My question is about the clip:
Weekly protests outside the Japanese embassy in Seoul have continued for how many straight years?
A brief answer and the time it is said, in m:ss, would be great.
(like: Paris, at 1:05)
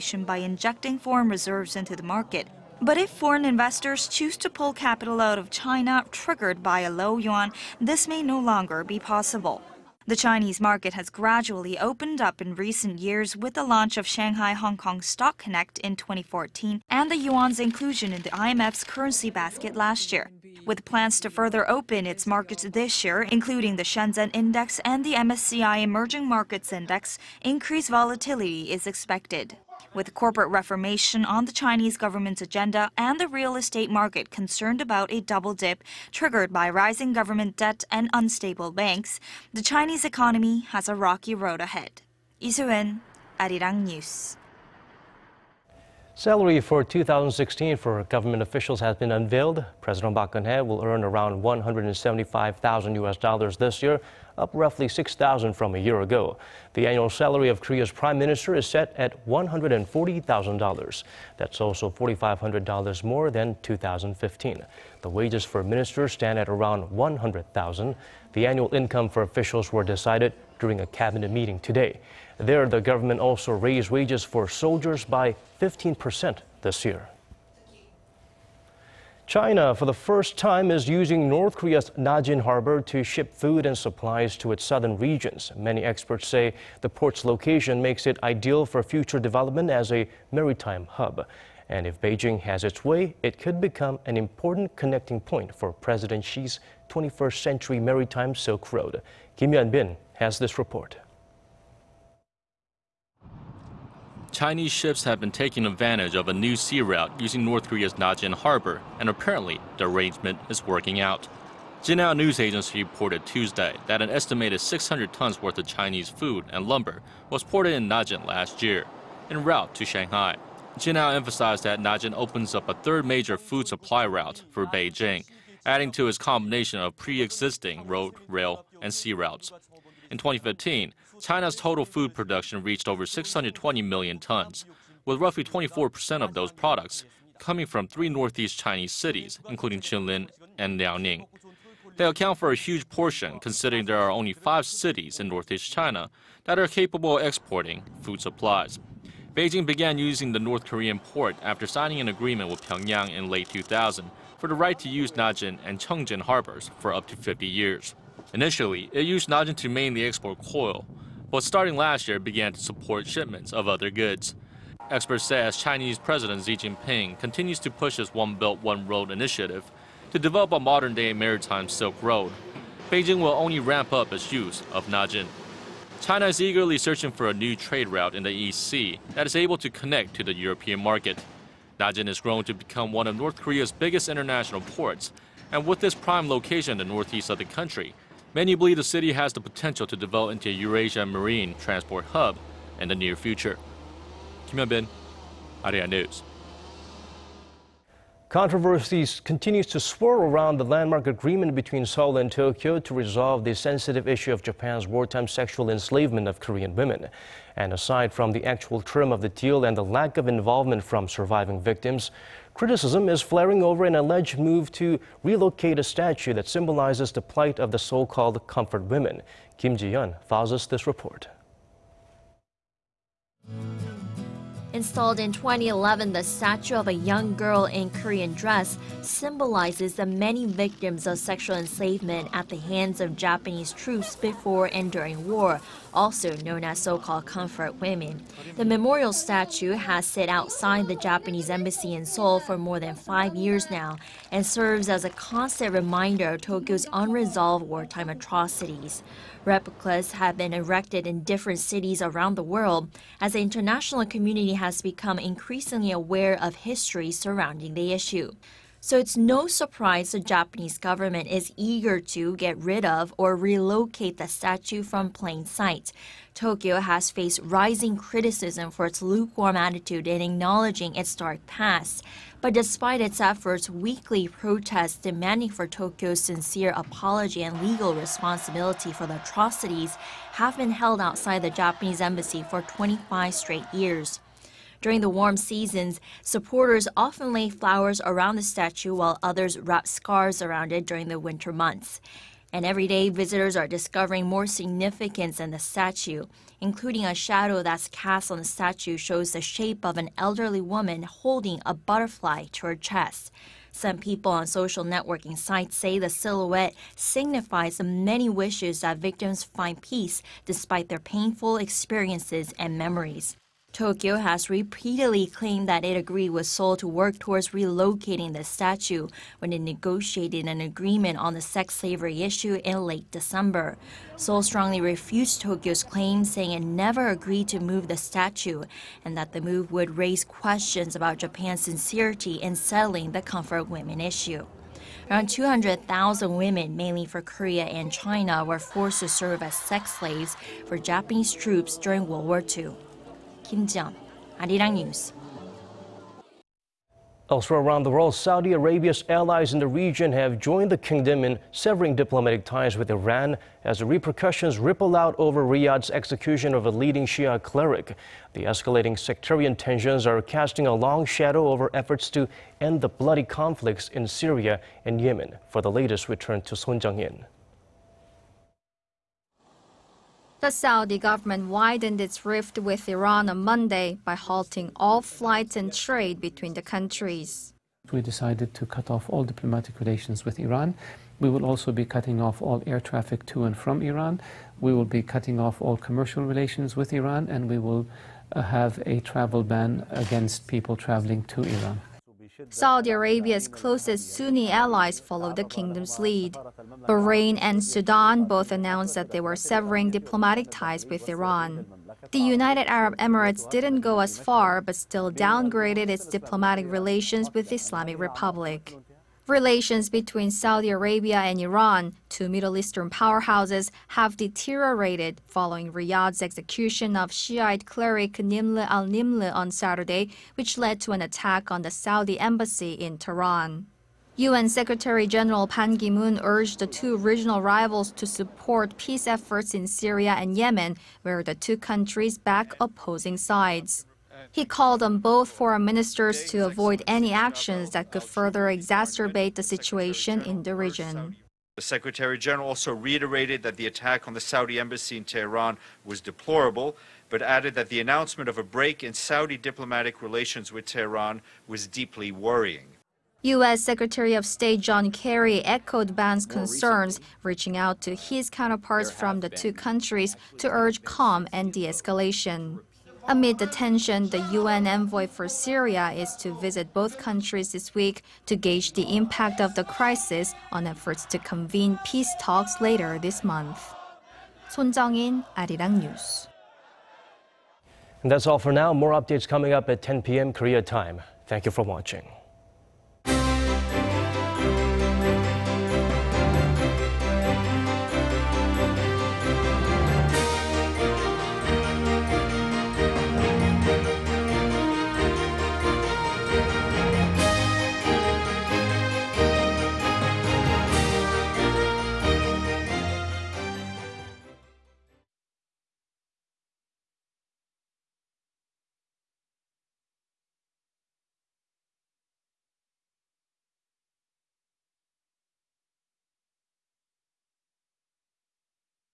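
25, at 4:42.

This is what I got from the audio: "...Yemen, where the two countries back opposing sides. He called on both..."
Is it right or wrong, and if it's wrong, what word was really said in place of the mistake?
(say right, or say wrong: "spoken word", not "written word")
right.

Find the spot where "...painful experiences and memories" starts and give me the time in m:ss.
5:10.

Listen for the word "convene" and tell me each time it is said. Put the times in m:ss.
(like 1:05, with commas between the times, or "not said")
7:51.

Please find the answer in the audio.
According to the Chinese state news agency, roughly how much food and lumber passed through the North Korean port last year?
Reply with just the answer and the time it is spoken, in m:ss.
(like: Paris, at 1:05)
600 tons, at 1:54.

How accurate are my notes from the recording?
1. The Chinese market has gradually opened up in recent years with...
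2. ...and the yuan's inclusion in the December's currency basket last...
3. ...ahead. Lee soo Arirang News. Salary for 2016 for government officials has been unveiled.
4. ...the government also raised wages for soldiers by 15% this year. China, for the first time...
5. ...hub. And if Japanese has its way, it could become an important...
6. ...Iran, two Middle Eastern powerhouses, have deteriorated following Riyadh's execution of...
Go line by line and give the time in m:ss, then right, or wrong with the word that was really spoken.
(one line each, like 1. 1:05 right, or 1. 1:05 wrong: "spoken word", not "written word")
1. 0:10 right
2. 0:16 wrong: "IMF", not "December"
3. 0:41 right
4. 1:12 right
5. 1:30 wrong: "Beijing", not "Japanese"
6. 6:51 right.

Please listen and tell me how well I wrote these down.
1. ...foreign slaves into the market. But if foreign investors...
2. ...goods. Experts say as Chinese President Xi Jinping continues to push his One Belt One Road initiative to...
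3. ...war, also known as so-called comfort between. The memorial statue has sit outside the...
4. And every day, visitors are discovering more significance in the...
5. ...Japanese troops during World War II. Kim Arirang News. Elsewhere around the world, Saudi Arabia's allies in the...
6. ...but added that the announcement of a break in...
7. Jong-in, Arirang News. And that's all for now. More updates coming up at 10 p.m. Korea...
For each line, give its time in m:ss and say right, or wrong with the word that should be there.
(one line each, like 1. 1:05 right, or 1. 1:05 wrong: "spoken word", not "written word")
1. 0:00 wrong: "reserves", not "slaves"
2. 2:43 right
3. 3:55 wrong: "women", not "between"
4. 4:52 right
5. 5:40 right
6. 7:27 right
7. 7:54 right.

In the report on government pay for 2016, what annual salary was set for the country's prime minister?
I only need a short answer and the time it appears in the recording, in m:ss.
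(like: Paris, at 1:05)
$140,000, at 0:59.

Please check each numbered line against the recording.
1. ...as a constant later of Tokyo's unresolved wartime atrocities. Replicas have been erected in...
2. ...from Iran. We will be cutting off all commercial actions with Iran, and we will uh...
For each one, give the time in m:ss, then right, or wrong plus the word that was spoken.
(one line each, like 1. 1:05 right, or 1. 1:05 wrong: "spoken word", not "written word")
1. 4:04 wrong: "reminder", not "later"
2. 6:23 wrong: "relations", not "actions".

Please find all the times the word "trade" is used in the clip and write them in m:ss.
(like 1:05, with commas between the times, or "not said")
2:57, 6:15.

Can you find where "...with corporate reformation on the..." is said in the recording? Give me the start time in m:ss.
0:29.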